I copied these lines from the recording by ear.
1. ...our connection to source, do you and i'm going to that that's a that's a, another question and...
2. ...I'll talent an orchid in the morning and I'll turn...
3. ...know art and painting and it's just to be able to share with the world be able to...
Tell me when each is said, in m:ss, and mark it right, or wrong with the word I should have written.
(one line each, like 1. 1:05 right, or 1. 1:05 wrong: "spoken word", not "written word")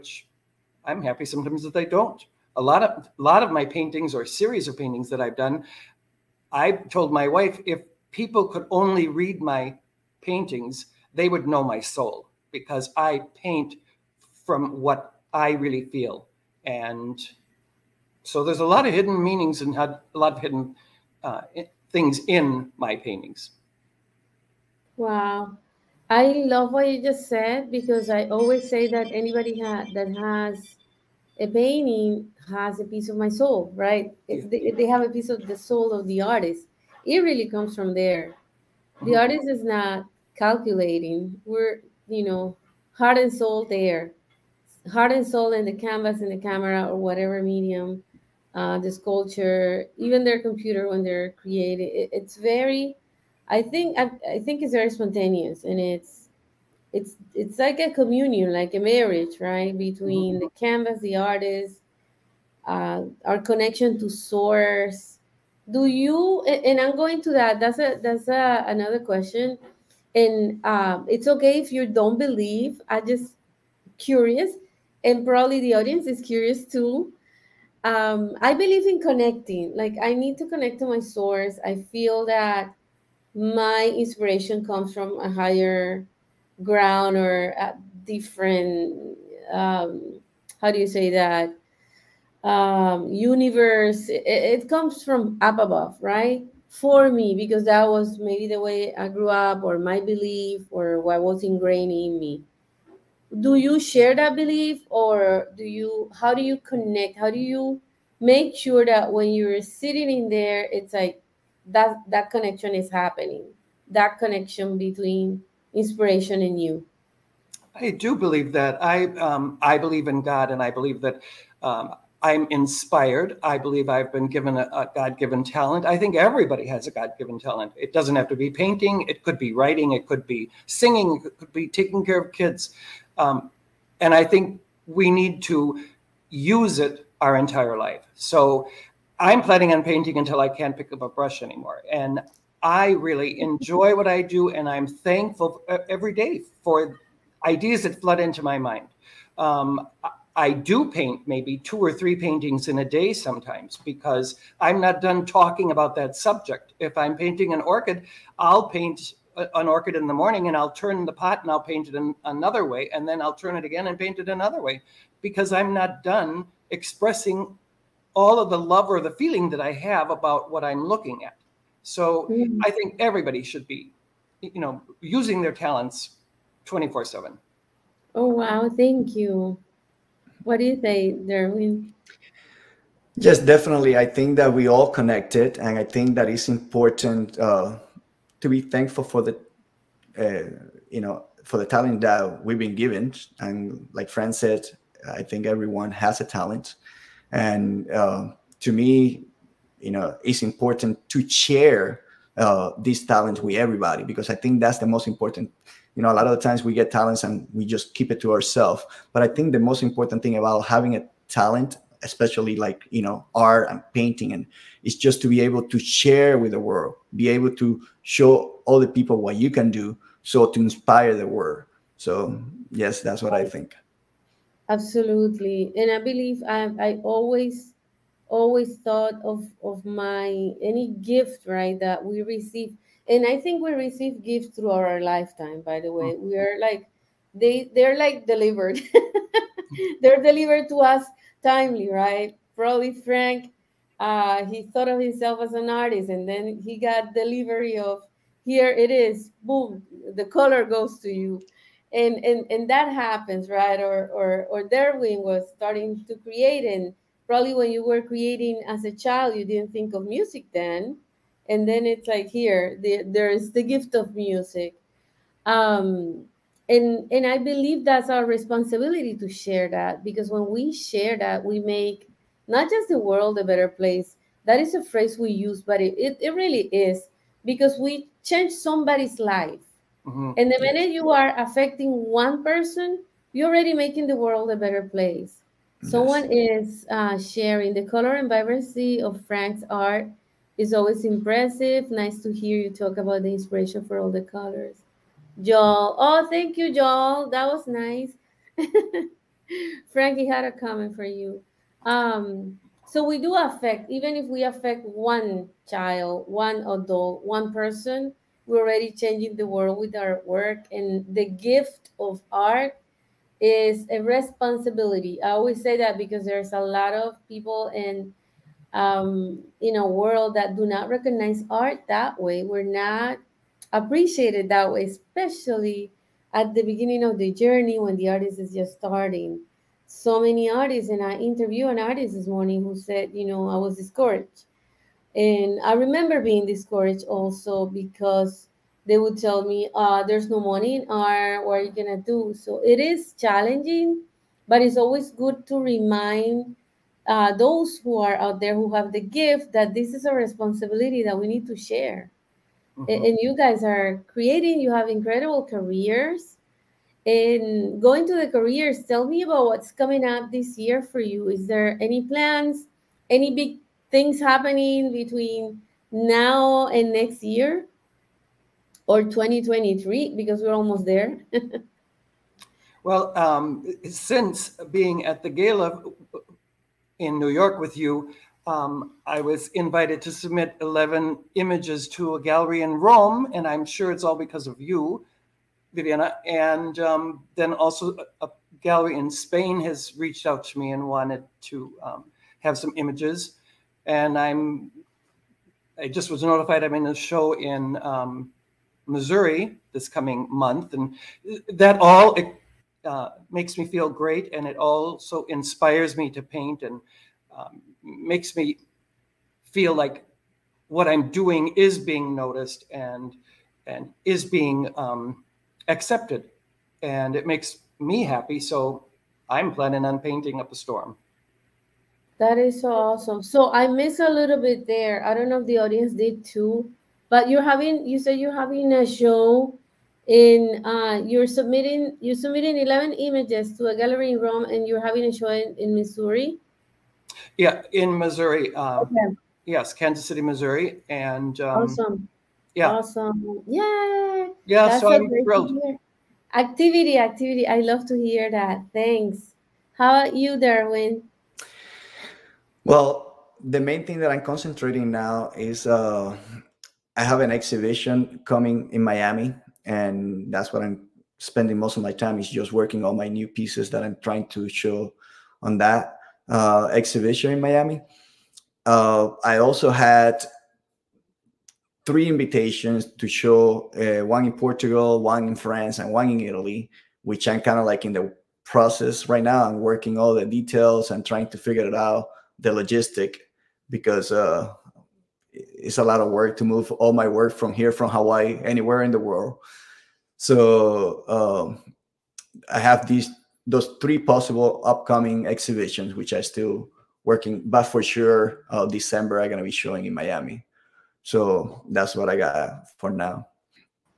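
1. 1:03 right
2. 2:38 wrong: "paint", not "talent"
3. 3:33 right.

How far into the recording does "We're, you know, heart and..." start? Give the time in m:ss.
0:41.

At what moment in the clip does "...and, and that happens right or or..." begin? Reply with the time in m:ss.
4:12.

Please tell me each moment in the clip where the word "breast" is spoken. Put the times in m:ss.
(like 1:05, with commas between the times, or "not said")
not said.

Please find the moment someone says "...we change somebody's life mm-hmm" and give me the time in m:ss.
4:37.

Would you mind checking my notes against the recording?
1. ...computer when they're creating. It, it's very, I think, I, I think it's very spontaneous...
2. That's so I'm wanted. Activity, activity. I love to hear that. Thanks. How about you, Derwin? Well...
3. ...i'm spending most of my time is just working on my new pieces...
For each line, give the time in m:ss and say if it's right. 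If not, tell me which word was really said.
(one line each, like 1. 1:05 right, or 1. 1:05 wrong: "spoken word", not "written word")
1. 0:50 right
2. 7:24 wrong: "thrilled", not "wanted"
3. 7:40 right.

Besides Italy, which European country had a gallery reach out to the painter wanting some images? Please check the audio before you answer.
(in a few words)
Spain.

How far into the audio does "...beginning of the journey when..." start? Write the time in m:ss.
5:26.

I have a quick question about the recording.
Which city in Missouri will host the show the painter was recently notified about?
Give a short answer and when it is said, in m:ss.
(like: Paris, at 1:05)
Kansas City, at 7:19.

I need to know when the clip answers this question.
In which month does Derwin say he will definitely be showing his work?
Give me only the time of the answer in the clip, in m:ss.
8:18.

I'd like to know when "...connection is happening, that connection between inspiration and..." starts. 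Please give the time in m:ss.
1:52.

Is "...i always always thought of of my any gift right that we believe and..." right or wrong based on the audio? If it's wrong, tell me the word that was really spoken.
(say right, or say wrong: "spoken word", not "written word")
wrong: "receive", not "believe".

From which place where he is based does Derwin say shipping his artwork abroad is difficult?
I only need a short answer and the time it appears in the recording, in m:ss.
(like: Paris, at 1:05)
Hawaii, at 8:07.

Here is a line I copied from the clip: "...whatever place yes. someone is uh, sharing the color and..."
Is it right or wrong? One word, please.
wrong.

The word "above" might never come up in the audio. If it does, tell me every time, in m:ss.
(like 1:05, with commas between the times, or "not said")
1:35.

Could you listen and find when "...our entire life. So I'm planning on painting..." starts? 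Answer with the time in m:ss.
2:17.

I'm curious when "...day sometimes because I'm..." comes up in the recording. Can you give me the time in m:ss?
2:32.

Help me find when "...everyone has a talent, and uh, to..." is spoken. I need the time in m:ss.
3:15.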